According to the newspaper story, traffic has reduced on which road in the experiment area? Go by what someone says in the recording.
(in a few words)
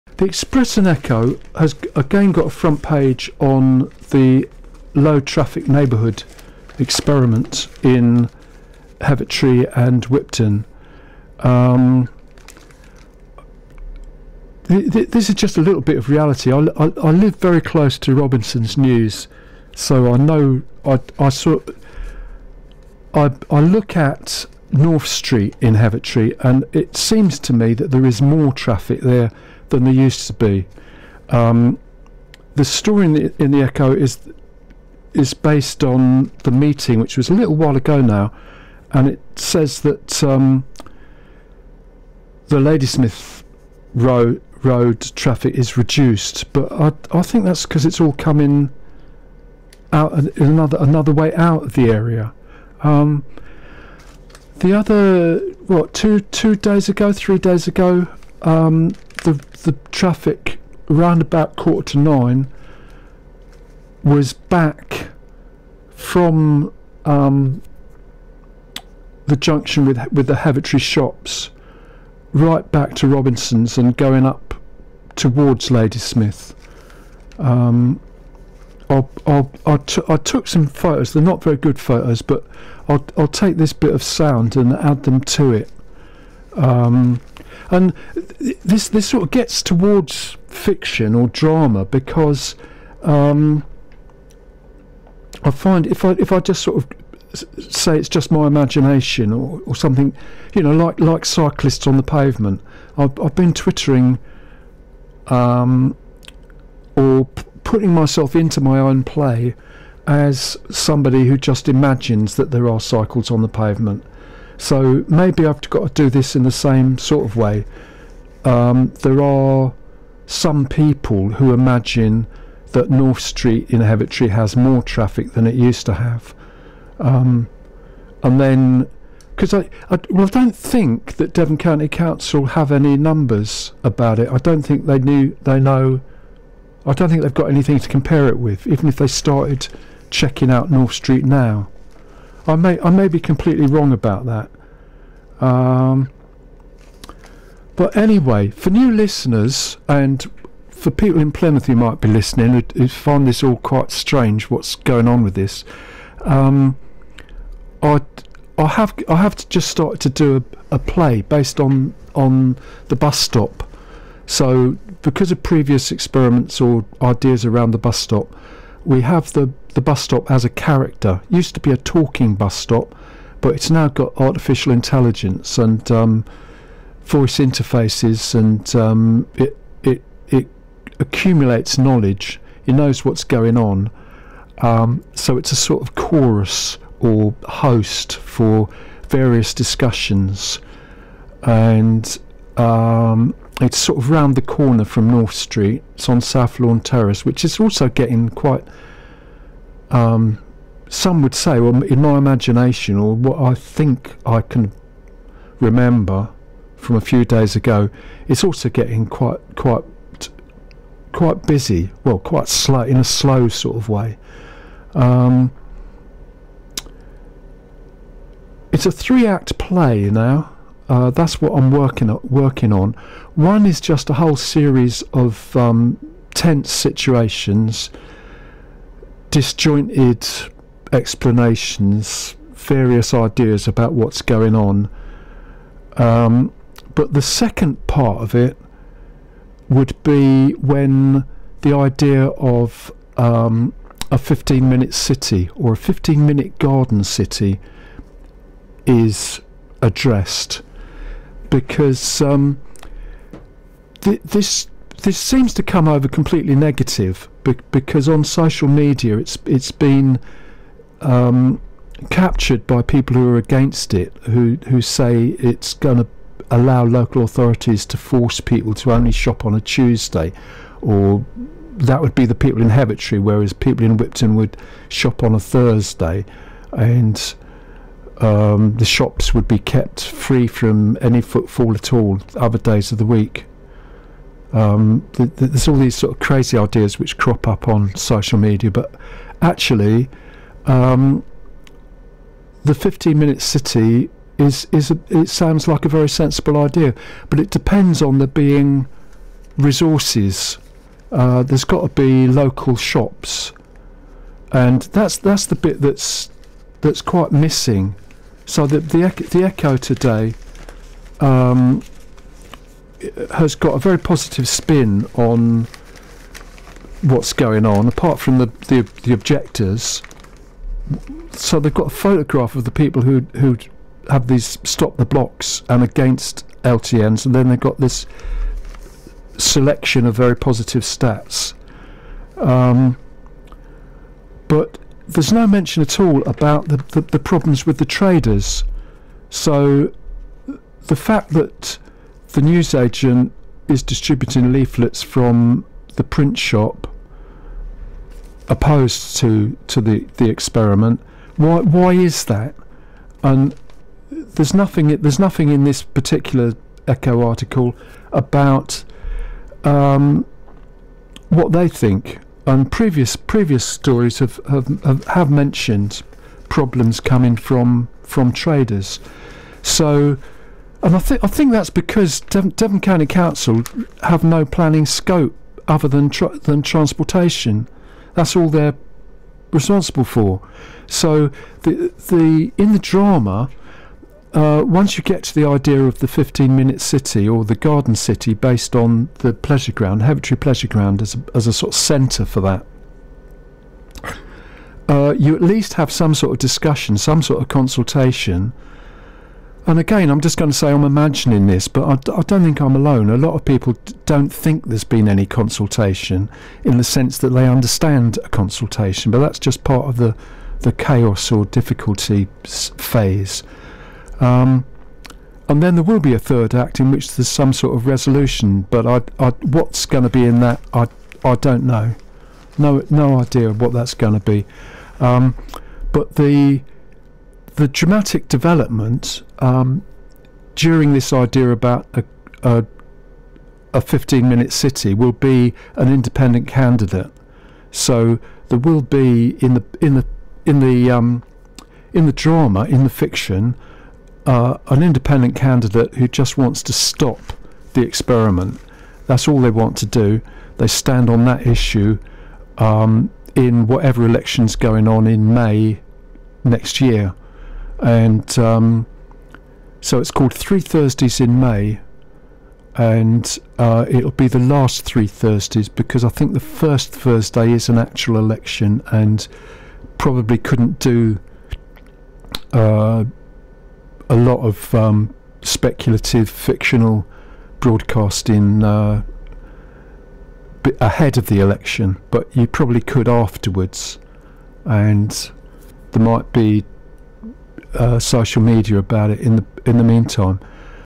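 Ladysmith Road.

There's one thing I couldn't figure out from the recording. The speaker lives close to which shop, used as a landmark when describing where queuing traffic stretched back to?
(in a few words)
Robinson's News.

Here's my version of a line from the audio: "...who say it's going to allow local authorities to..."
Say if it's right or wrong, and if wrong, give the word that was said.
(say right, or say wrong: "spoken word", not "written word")
right.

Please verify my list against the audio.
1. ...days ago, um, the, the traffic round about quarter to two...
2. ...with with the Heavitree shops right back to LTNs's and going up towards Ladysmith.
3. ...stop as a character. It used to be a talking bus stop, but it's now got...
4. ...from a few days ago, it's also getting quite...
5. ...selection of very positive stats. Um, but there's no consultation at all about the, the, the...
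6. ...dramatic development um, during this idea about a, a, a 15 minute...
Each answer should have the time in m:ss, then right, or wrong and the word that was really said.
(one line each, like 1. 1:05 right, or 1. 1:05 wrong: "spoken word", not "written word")
1. 0:57 wrong: "nine", not "two"
2. 1:09 wrong: "Robinson", not "LTNs"
3. 2:50 right
4. 3:26 right
5. 5:29 wrong: "mention", not "consultation"
6. 7:07 right.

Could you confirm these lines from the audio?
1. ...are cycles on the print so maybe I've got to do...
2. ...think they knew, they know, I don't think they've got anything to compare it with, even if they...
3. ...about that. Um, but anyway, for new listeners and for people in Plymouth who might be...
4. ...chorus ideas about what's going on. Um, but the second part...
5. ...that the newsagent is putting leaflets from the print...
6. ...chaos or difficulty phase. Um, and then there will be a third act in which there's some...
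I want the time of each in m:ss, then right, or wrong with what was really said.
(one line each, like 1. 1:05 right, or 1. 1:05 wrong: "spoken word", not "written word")
1. 1:52 wrong: "pavement", not "print"
2. 2:14 right
3. 2:23 right
4. 3:52 wrong: "various", not "chorus"
5. 5:41 wrong: "distributing", not "putting"
6. 6:50 right.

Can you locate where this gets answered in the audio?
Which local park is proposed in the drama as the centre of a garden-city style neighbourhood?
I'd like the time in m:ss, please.
6:30.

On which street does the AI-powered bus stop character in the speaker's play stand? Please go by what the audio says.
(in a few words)
South Lawn Terrace.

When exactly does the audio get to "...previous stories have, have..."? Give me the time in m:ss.
6:03.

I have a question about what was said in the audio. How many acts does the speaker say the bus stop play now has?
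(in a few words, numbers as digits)
3.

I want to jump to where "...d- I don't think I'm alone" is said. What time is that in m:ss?
6:41.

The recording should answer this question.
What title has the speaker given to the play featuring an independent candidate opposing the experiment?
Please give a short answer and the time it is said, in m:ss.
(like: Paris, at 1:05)
Three Thursdays in May, at 7:40.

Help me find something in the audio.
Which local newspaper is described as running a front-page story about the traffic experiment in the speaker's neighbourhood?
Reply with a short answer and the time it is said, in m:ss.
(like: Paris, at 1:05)
Express and Echo, at 0:00.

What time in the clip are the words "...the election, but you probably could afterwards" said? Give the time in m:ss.
8:01.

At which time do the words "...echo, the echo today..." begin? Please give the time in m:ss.
5:09.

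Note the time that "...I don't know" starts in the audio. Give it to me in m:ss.
7:01.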